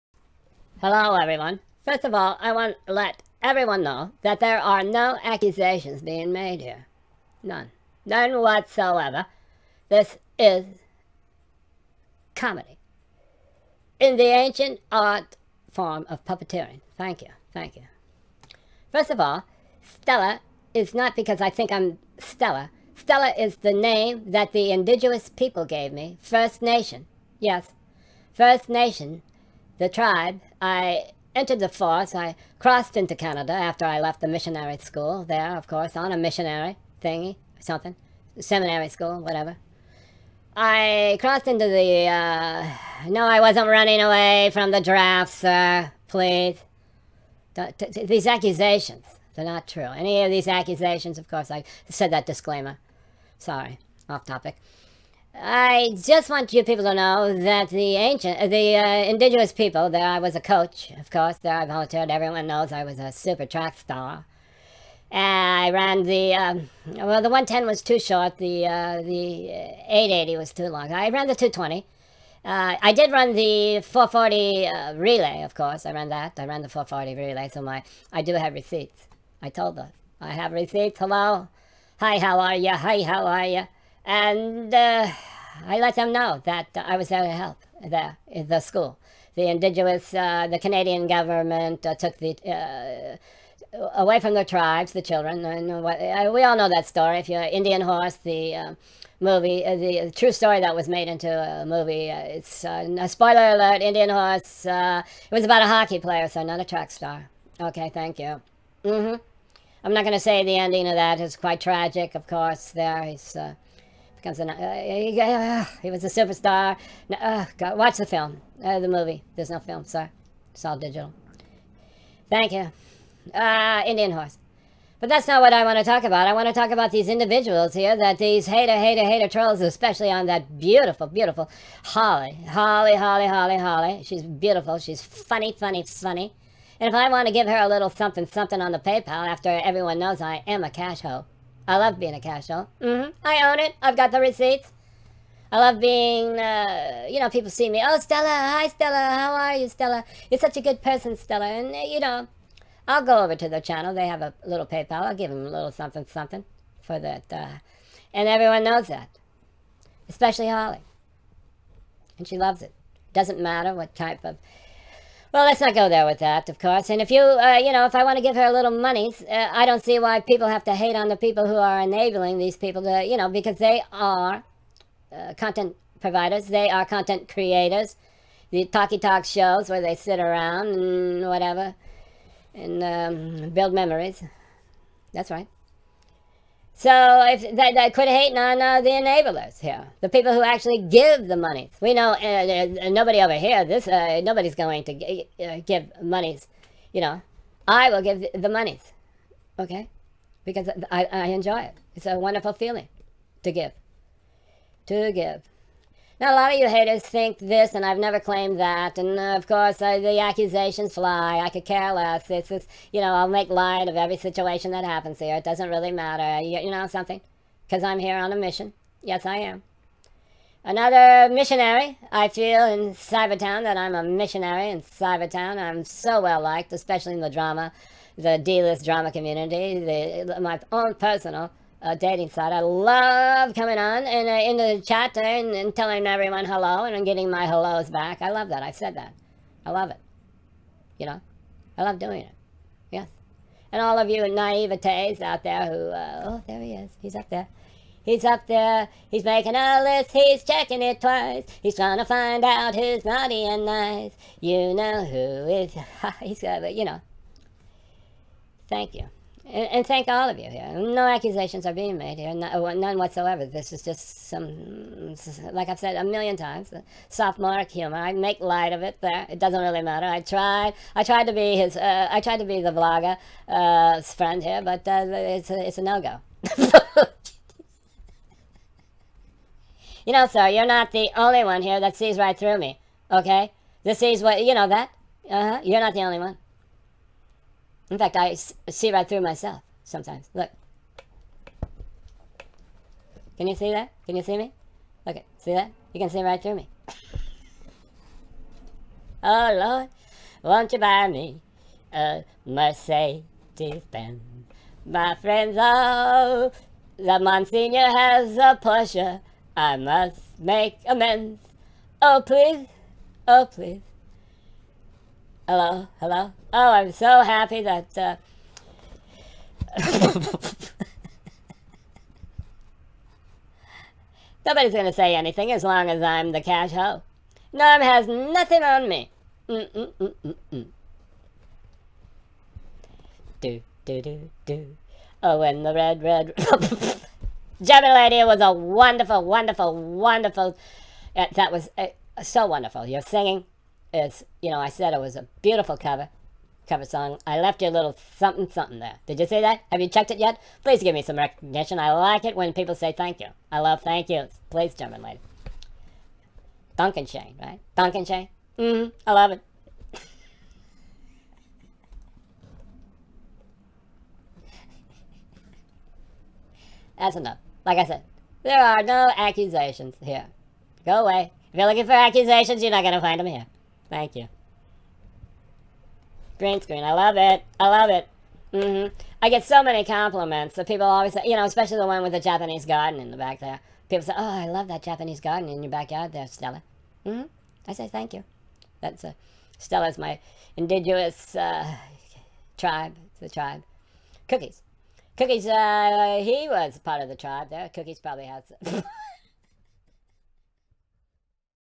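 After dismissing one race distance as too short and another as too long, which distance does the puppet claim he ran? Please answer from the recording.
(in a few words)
220.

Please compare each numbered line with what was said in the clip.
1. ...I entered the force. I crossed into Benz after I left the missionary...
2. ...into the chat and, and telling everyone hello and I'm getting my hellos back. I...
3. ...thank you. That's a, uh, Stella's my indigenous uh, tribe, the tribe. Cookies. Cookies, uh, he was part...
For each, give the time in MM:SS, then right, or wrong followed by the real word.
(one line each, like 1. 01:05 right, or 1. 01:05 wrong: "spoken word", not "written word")
1. 00:30 wrong: "Canada", not "Benz"
2. 03:54 right
3. 06:27 right.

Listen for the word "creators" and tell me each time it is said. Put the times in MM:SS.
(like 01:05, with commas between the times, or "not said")
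02:57.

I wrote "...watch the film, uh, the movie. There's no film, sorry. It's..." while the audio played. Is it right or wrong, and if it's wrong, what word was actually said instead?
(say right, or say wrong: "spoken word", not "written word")
right.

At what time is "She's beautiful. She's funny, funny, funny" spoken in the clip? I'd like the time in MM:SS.
02:14.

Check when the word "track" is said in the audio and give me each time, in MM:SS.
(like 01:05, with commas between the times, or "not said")
01:03, 01:46.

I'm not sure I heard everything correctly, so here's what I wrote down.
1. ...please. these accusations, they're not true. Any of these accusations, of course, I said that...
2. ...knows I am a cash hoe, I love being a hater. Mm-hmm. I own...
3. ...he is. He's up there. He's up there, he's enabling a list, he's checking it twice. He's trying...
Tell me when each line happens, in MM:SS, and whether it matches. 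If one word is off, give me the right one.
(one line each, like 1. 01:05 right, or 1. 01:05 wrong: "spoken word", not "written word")
1. 00:46 right
2. 02:19 wrong: "casher", not "hater"
3. 04:06 wrong: "making", not "enabling".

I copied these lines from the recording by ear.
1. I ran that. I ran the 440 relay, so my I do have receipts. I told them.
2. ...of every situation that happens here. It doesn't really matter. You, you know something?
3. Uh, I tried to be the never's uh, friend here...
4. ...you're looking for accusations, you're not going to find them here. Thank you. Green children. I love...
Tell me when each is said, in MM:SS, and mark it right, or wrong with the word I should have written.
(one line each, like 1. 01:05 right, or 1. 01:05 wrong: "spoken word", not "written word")
1. 01:15 right
2. 03:33 right
3. 04:31 wrong: "vlogger", not "never"
4. 06:11 wrong: "screen", not "children".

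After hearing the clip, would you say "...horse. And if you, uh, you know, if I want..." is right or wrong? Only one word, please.
wrong.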